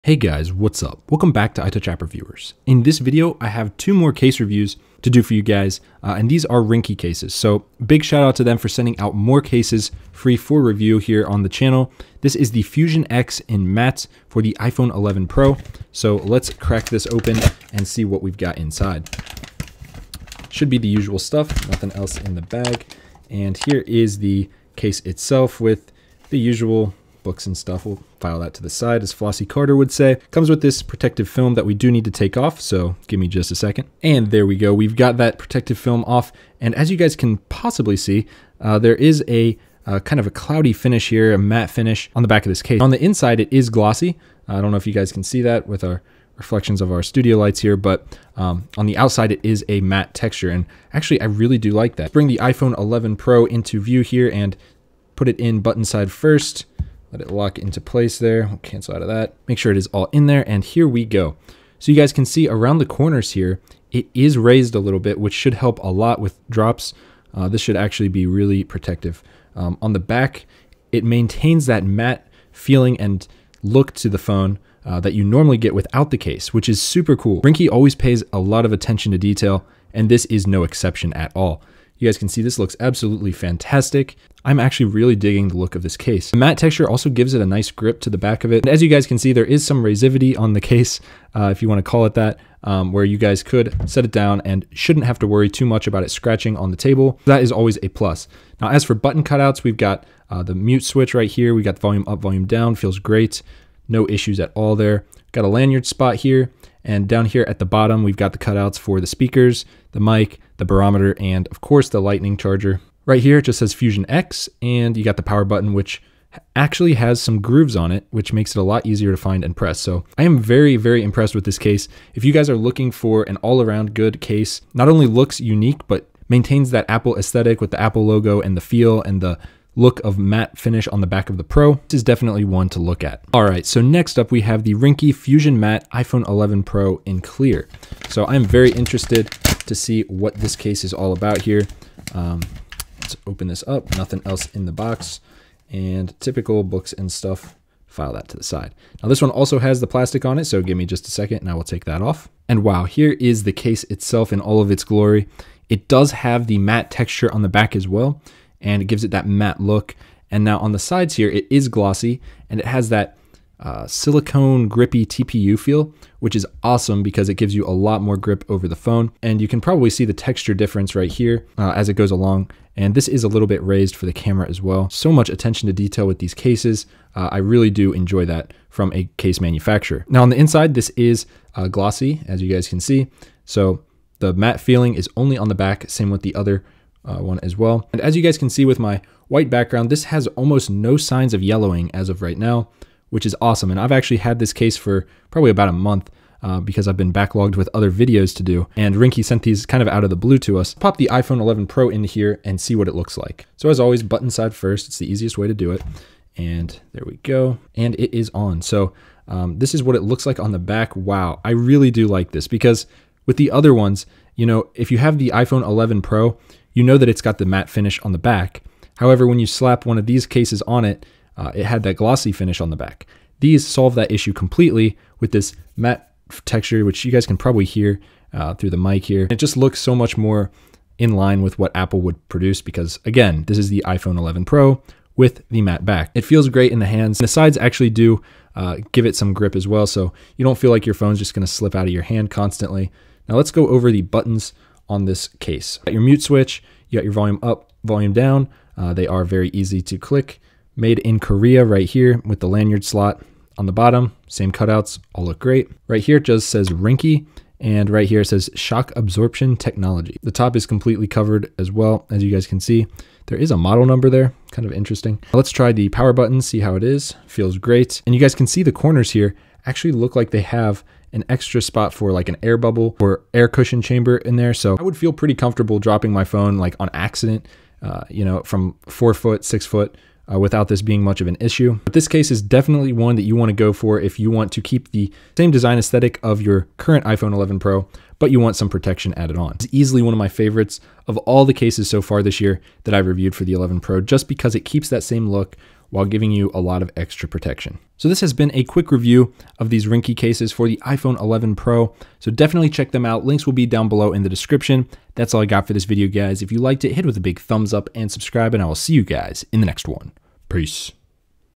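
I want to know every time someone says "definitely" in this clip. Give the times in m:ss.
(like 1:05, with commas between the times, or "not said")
2:12, 4:42, 5:02.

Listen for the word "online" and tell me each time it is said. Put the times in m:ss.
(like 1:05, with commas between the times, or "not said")
not said.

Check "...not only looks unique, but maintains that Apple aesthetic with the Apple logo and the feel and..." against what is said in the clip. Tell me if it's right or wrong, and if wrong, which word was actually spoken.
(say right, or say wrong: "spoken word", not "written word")
right.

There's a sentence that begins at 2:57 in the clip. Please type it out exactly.
Uh, I really do enjoy that from a case manufacturer.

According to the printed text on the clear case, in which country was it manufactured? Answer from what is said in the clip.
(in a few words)
Korea.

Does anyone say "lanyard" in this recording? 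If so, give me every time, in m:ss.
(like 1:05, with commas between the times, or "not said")
1:45, 4:12.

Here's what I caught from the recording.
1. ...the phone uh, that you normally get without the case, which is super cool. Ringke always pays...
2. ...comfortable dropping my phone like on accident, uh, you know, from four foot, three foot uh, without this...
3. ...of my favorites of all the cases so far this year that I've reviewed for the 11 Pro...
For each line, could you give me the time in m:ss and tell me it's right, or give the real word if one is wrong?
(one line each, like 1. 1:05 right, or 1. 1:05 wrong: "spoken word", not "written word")
1. 1:14 right
2. 4:35 wrong: "six", not "three"
3. 4:50 right.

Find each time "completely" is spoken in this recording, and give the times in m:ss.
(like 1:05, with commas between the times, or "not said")
3:44, 4:20.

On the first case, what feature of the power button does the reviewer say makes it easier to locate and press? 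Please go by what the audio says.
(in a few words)
grooves.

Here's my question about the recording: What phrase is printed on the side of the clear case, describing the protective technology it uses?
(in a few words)
shock absorption technology.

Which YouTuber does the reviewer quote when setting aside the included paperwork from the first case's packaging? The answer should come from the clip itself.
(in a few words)
Flossie Carter.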